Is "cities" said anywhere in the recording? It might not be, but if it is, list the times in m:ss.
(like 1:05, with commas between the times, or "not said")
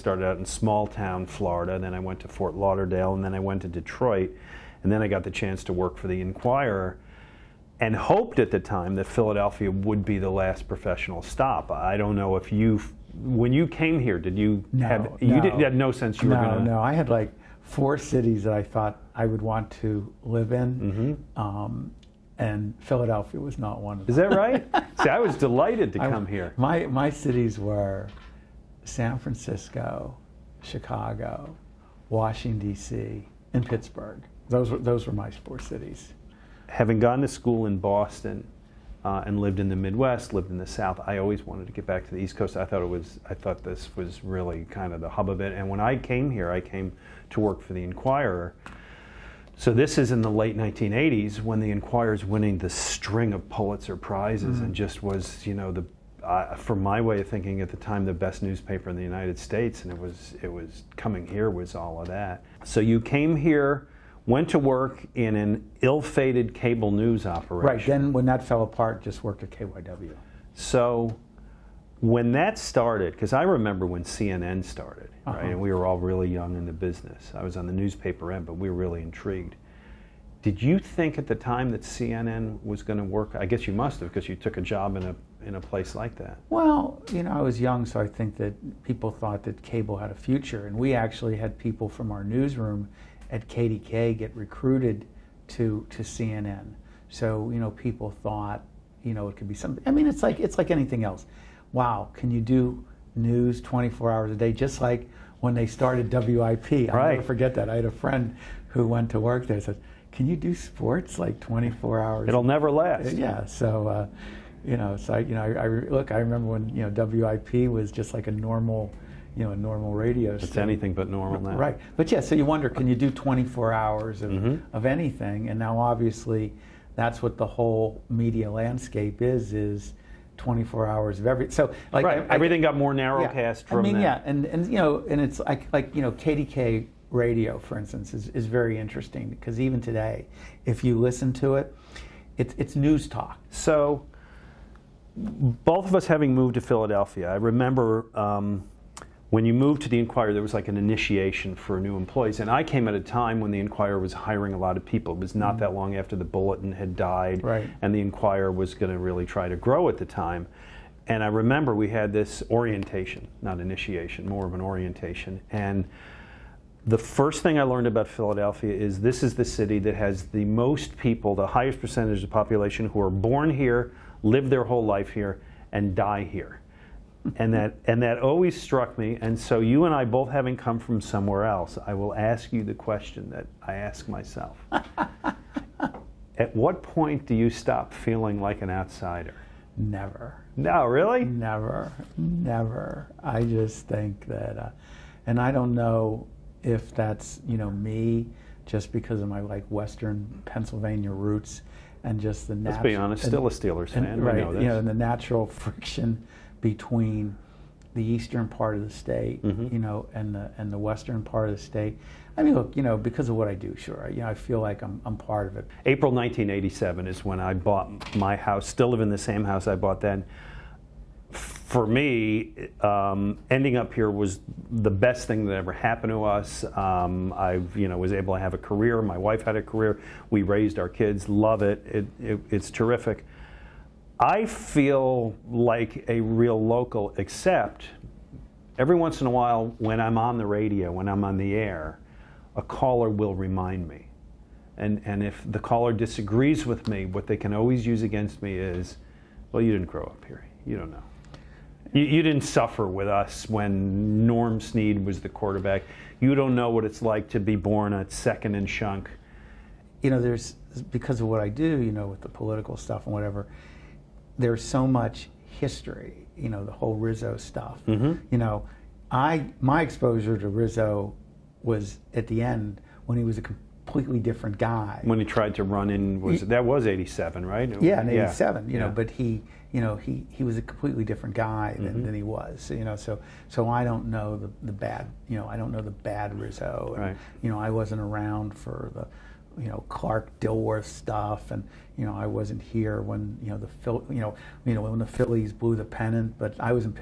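0:17, 0:27, 0:35.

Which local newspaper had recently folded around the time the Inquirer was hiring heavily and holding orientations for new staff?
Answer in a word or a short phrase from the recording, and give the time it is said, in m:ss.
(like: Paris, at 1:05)
The Bulletin, at 2:36.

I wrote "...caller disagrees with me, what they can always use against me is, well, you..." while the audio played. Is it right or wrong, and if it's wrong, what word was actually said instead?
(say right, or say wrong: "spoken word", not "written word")
right.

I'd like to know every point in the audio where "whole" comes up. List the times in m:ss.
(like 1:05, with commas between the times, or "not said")
2:07, 2:54, 4:26.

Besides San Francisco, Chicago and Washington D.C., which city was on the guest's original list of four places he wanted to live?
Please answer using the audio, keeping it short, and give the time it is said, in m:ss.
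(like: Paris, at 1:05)
Pittsburgh, at 0:33.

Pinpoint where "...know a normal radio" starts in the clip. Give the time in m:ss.
1:59.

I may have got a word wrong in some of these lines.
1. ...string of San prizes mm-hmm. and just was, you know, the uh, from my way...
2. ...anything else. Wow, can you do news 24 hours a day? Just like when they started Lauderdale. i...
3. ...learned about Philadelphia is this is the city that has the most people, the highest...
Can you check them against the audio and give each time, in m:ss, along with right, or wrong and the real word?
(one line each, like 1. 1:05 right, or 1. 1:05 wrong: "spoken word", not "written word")
1. 0:52 wrong: "Pulitzer", not "San"
2. 1:40 wrong: "WIP", not "Lauderdale"
3. 2:47 right.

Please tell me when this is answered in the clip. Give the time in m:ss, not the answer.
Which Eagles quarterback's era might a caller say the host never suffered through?
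4:14.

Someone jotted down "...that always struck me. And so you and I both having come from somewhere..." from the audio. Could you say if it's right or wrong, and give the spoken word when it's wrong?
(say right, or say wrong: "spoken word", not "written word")
right.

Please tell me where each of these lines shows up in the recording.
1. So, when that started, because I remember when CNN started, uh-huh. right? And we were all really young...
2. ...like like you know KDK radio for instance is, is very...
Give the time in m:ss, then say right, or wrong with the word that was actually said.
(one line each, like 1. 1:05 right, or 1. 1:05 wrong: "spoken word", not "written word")
1. 1:10 right
2. 2:15 right.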